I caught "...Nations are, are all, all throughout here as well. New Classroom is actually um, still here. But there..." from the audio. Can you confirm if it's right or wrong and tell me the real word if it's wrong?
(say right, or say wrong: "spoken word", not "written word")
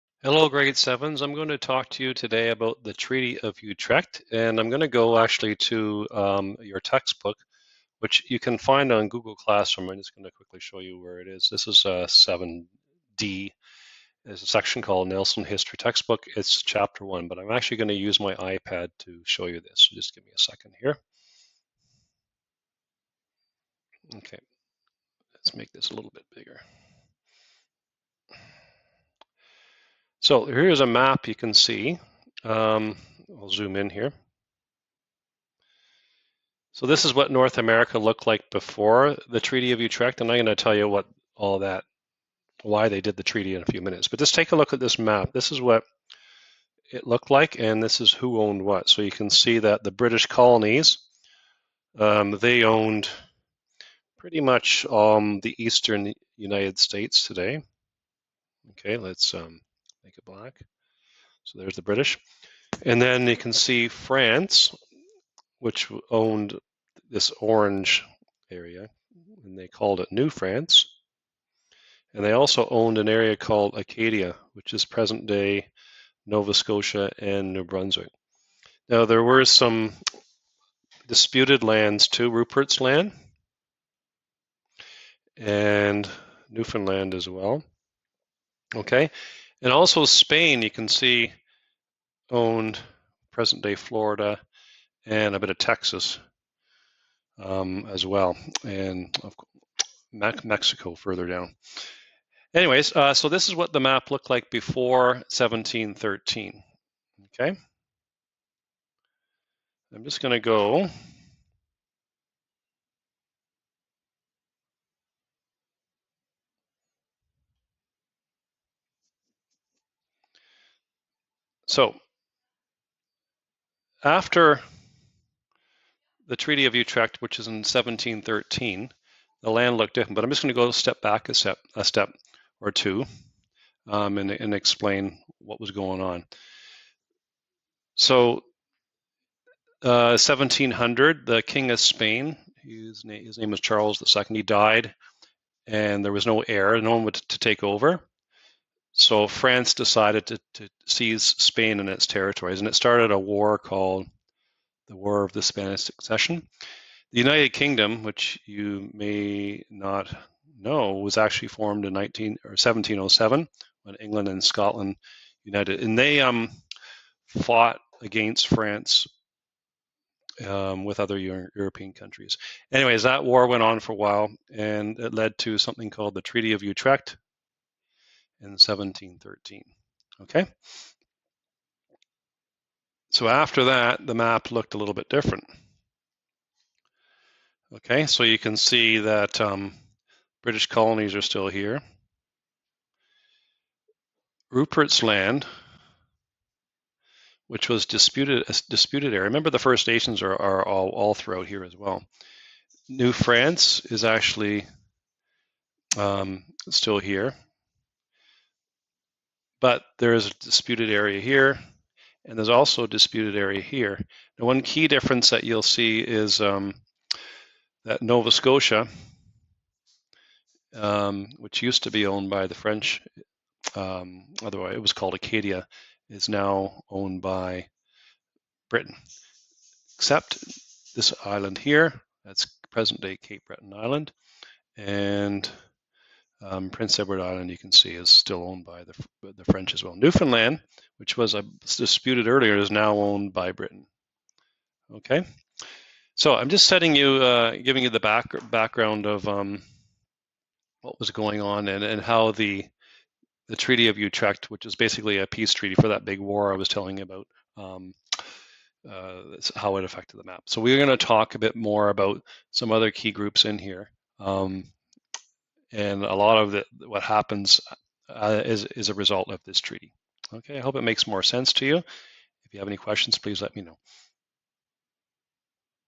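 wrong: "France", not "Classroom".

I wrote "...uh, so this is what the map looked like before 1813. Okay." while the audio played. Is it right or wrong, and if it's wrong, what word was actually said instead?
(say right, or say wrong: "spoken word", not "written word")
wrong: "1713", not "1813".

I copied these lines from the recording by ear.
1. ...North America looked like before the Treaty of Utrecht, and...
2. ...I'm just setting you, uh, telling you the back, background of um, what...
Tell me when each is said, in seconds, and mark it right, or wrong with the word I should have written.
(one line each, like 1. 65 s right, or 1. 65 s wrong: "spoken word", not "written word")
1. 37 s right
2. 246 s wrong: "giving", not "telling".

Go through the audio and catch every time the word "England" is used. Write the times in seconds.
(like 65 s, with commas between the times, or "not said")
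163 s.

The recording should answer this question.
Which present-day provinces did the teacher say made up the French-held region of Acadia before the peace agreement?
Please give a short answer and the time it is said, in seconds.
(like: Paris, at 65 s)
Nova Scotia and New Brunswick, at 76 s.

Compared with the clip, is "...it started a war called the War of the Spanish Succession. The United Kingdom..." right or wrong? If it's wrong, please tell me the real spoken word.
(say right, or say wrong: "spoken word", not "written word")
right.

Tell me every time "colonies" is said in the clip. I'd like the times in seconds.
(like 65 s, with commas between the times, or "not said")
50 s, 190 s.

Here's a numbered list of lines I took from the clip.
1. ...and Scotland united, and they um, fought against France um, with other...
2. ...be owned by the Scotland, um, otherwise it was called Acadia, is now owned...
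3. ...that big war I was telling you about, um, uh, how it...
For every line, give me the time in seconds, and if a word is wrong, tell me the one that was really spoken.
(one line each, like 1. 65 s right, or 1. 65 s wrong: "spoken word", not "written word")
1. 164 s right
2. 221 s wrong: "French", not "Scotland"
3. 255 s right.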